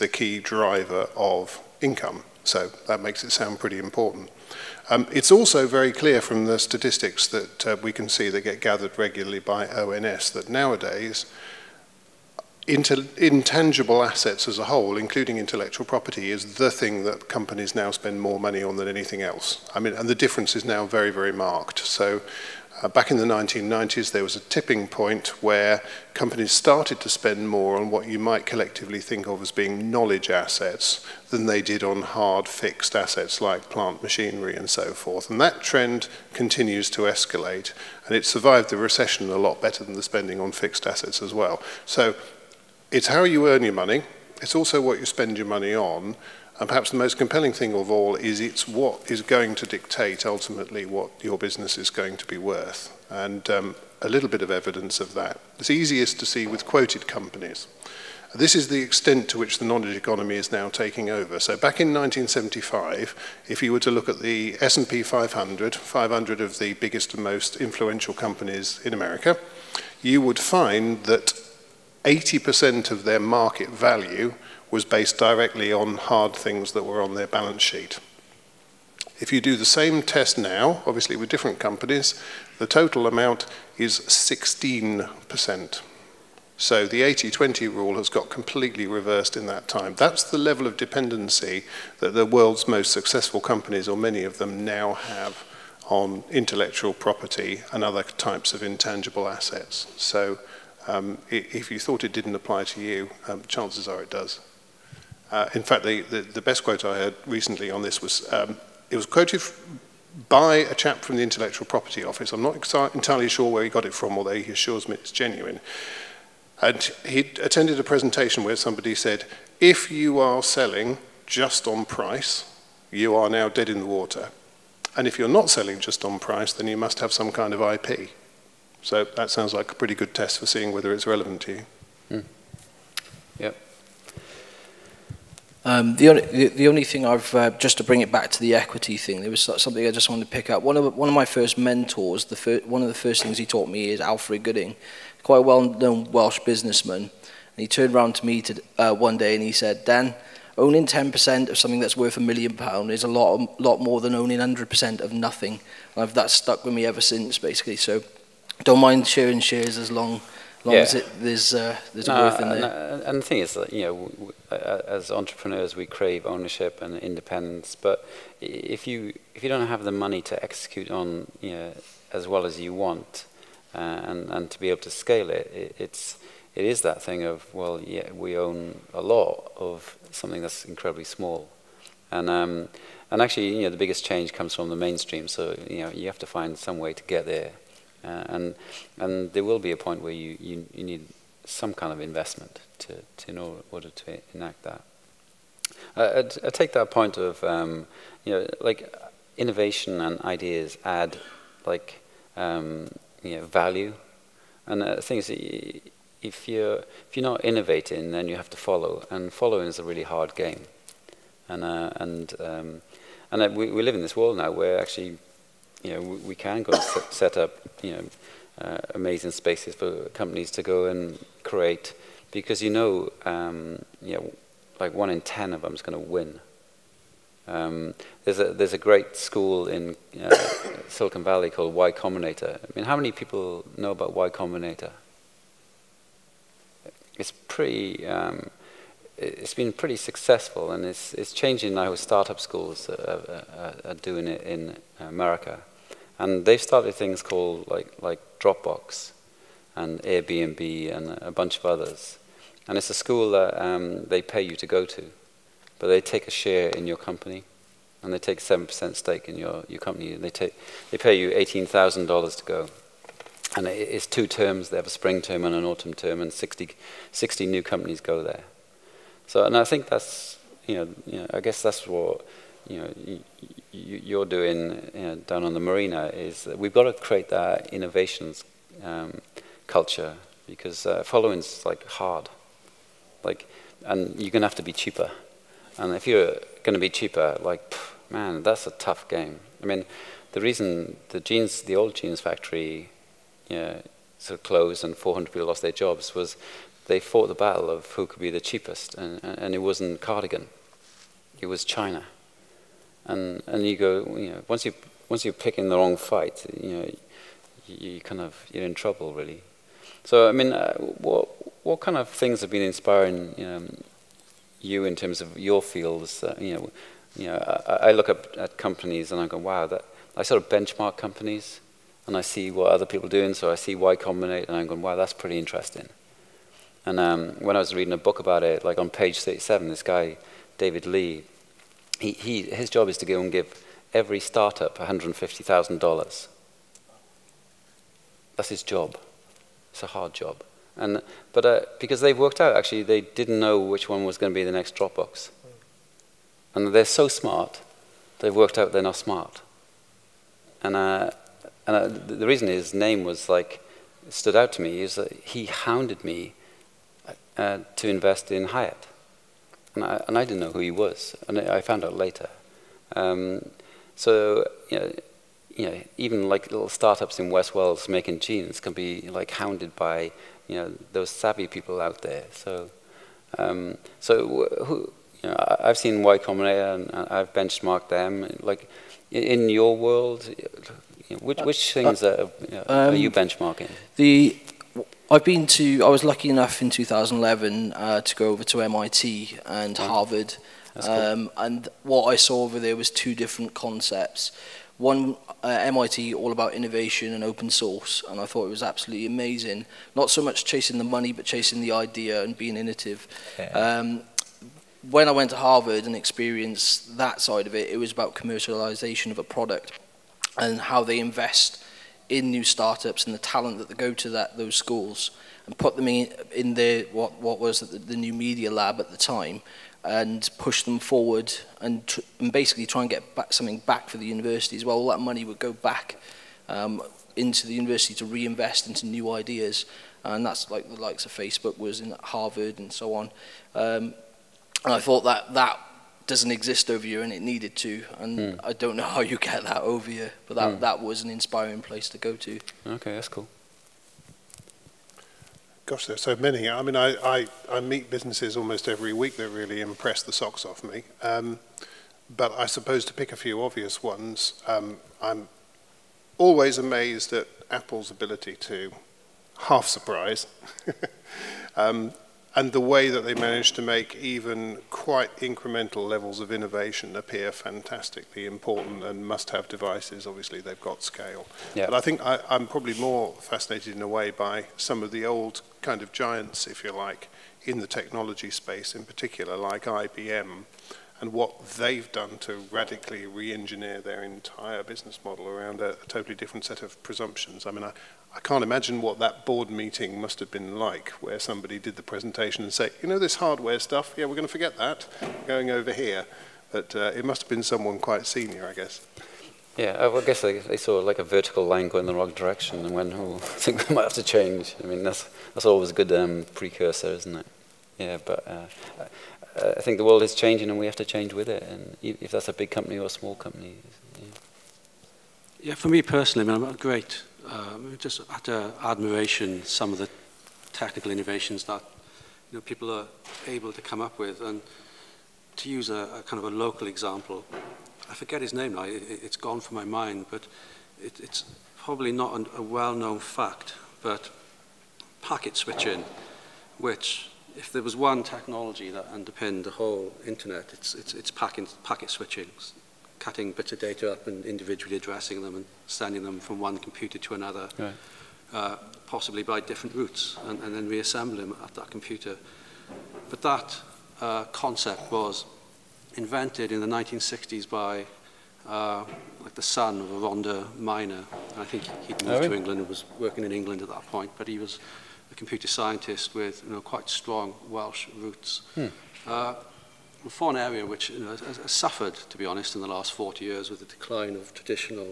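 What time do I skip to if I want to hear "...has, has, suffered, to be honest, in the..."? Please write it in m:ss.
9:31.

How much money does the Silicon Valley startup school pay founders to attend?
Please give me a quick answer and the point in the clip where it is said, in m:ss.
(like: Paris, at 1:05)
$18,000, at 4:21.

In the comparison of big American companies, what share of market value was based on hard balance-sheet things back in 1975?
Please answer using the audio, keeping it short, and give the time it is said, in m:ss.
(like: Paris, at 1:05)
80%, at 1:12.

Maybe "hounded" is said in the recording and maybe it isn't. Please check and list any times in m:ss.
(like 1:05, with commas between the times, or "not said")
5:55, 6:09.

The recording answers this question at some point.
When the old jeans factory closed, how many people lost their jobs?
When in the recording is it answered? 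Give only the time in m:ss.
4:54.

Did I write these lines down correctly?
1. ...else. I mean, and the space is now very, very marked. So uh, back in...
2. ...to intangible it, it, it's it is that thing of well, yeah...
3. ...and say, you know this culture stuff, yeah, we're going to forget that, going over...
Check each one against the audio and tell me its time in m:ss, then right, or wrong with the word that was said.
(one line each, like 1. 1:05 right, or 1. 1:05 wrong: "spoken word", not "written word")
1. 0:19 wrong: "difference", not "space"
2. 2:54 wrong: "scale", not "intangible"
3. 8:12 wrong: "hardware", not "culture".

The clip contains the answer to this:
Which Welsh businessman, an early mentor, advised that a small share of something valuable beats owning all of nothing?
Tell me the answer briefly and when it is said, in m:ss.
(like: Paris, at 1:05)
Alfred Gooding, at 2:23.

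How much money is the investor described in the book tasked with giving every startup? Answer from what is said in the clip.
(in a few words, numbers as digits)
$150,000.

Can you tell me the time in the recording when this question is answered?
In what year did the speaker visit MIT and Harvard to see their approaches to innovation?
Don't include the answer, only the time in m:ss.
6:26.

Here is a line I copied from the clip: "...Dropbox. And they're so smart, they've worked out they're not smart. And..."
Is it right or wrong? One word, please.
right.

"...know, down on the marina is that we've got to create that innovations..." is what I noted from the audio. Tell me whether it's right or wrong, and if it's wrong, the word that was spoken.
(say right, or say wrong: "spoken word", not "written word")
right.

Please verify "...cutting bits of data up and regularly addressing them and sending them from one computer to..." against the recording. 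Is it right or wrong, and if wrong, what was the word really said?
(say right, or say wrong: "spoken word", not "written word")
wrong: "individually", not "regularly".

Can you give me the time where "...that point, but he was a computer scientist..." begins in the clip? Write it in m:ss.
9:23.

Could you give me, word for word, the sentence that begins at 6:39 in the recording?
Not so much chasing the money, but chasing the idea and being innovative.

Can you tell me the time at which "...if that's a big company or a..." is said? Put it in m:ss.
8:31.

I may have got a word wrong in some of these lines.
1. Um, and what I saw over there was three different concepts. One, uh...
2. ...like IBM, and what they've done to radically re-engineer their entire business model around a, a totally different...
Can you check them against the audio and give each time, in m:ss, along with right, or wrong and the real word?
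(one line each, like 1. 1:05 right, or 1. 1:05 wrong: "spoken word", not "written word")
1. 6:30 wrong: "two", not "three"
2. 7:59 right.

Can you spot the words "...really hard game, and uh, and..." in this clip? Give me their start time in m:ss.
3:29.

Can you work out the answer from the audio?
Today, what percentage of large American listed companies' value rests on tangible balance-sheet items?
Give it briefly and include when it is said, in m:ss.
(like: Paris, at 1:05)
16%, at 1:24.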